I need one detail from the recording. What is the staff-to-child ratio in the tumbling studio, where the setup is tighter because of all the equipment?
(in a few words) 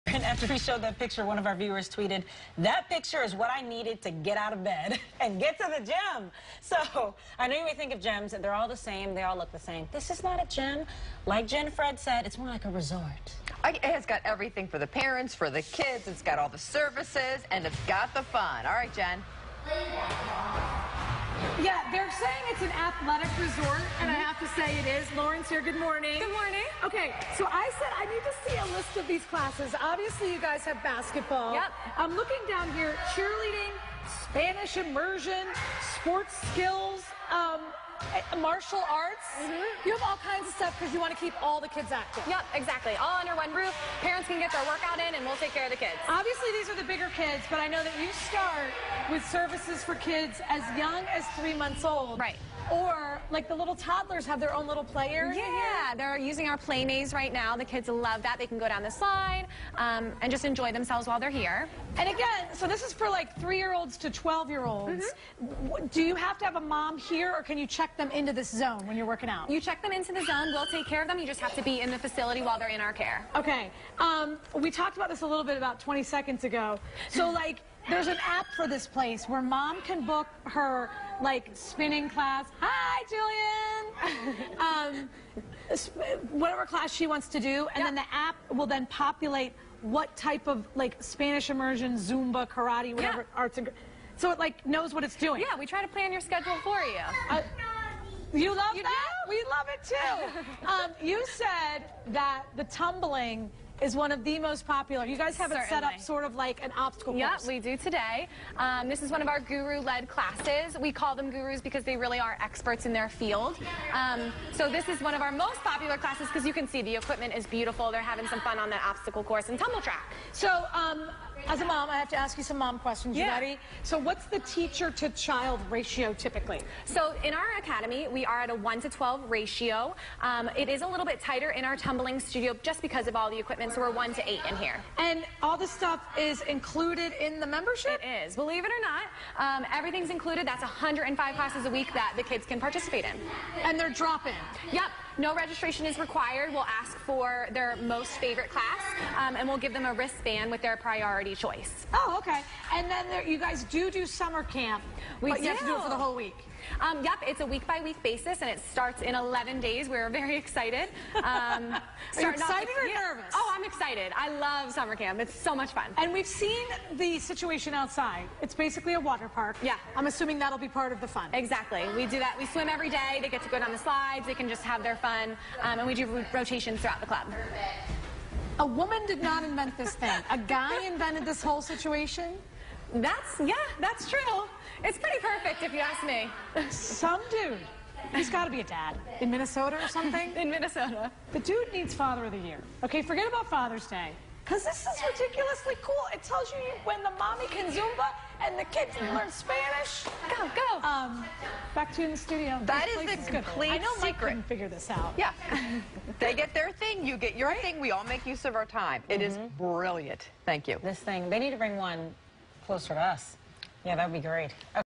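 1 to 8.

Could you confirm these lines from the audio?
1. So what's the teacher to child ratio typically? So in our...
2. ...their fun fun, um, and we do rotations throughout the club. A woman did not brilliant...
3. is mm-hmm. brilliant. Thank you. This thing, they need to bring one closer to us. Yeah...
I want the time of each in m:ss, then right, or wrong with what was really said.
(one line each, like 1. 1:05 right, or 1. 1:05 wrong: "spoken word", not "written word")
1. 2:03 right
2. 2:54 wrong: "invent", not "brilliant"
3. 3:29 right.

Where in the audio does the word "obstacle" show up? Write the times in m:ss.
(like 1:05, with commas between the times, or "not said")
1:46, 1:58.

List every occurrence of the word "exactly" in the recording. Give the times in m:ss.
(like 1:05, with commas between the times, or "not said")
0:42, 2:51.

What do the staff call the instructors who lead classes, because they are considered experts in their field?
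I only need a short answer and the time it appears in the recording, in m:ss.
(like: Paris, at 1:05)
Gurus, at 1:51.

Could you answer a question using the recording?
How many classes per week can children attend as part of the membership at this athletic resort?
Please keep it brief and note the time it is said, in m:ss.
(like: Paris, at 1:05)
105, at 2:20.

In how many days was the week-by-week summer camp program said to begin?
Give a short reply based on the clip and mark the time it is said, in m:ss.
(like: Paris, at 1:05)
11 days, at 2:39.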